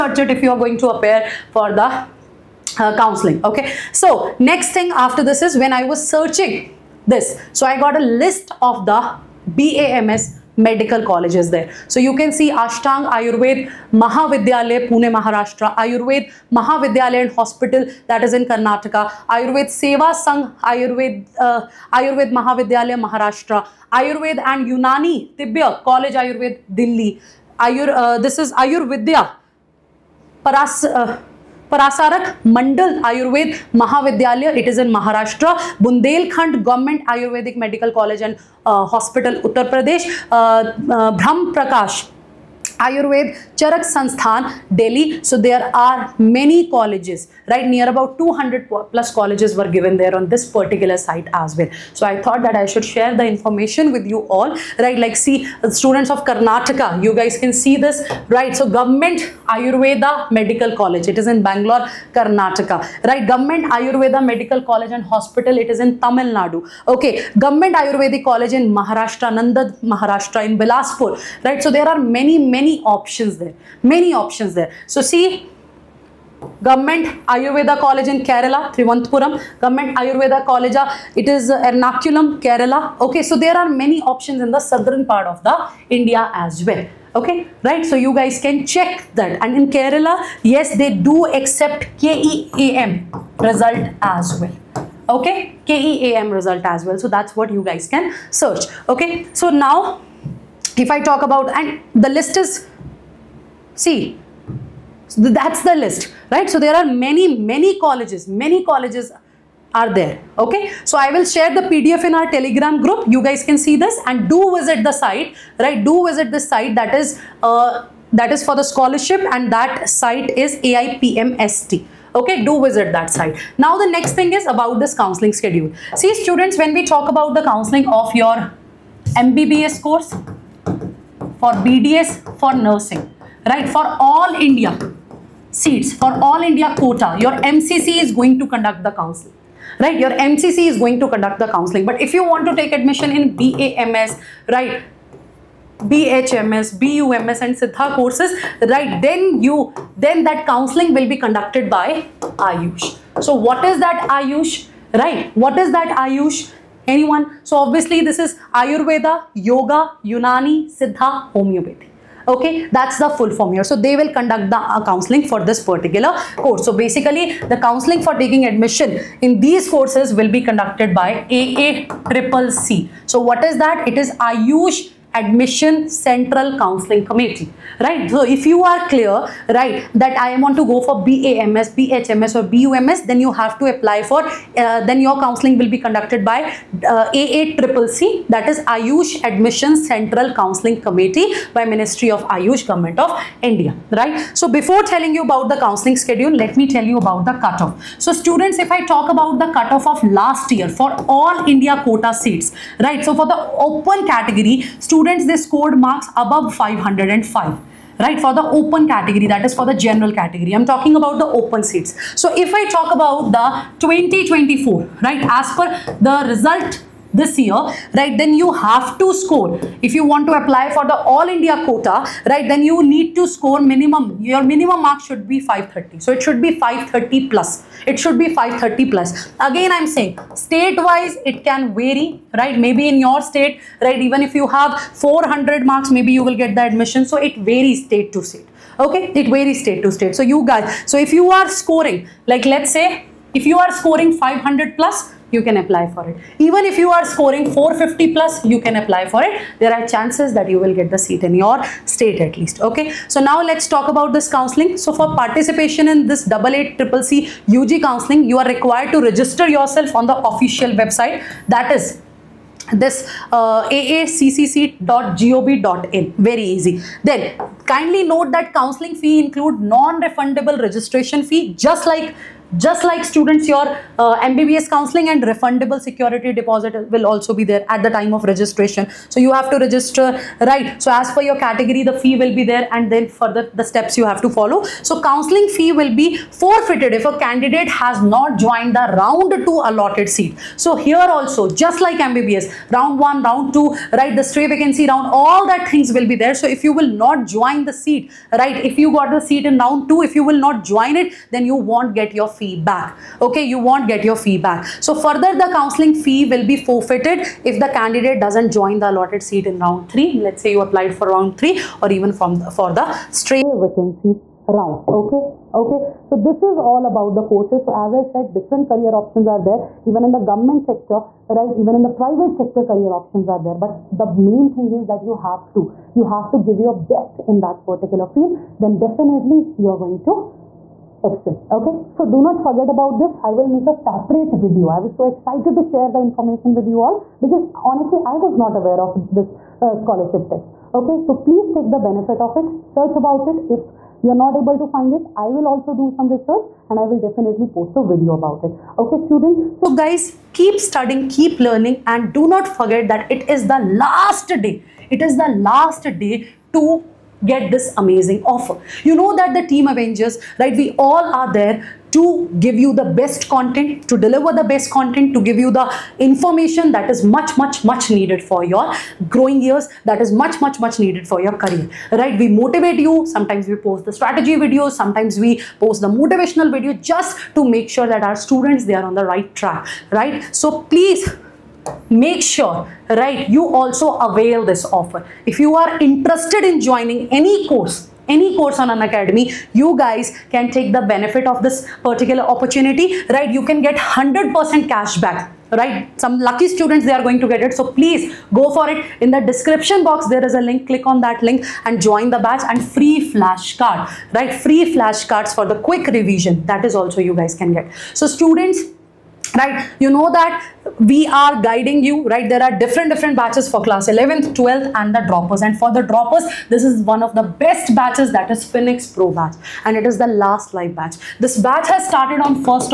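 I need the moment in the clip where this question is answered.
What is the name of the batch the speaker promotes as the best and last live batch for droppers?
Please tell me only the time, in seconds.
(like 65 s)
418 s.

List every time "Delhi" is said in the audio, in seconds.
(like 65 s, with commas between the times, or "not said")
26 s, 44 s.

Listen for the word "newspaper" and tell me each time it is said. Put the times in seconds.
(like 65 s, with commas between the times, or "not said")
not said.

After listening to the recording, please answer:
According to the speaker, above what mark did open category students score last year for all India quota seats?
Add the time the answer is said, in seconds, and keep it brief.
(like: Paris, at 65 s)
505, at 206 s.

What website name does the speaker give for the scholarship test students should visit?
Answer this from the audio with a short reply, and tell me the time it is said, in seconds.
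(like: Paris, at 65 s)
AIPMST, at 120 s.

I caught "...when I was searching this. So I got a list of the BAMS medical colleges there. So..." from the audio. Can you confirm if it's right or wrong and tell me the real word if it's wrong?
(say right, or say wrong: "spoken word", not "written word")
right.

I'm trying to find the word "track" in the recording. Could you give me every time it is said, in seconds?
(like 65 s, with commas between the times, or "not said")
379 s.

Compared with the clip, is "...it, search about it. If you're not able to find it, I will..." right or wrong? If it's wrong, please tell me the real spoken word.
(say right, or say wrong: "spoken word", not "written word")
right.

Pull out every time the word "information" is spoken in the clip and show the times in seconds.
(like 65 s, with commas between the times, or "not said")
53 s, 335 s, 365 s.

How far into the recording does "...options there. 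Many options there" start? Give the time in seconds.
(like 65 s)
72 s.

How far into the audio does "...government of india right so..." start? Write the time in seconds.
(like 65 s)
192 s.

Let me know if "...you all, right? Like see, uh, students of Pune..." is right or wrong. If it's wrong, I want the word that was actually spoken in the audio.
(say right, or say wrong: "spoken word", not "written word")
wrong: "Karnataka", not "Pune".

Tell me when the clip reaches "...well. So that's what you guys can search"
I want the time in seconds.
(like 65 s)
96 s.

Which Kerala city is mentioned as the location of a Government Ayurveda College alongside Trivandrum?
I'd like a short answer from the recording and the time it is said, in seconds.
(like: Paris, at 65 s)
Ernakulam, at 81 s.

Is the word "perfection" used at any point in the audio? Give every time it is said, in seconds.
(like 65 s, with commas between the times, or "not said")
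not said.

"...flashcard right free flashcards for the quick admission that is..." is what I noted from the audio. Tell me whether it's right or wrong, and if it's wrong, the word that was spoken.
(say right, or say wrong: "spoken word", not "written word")
wrong: "revision", not "admission".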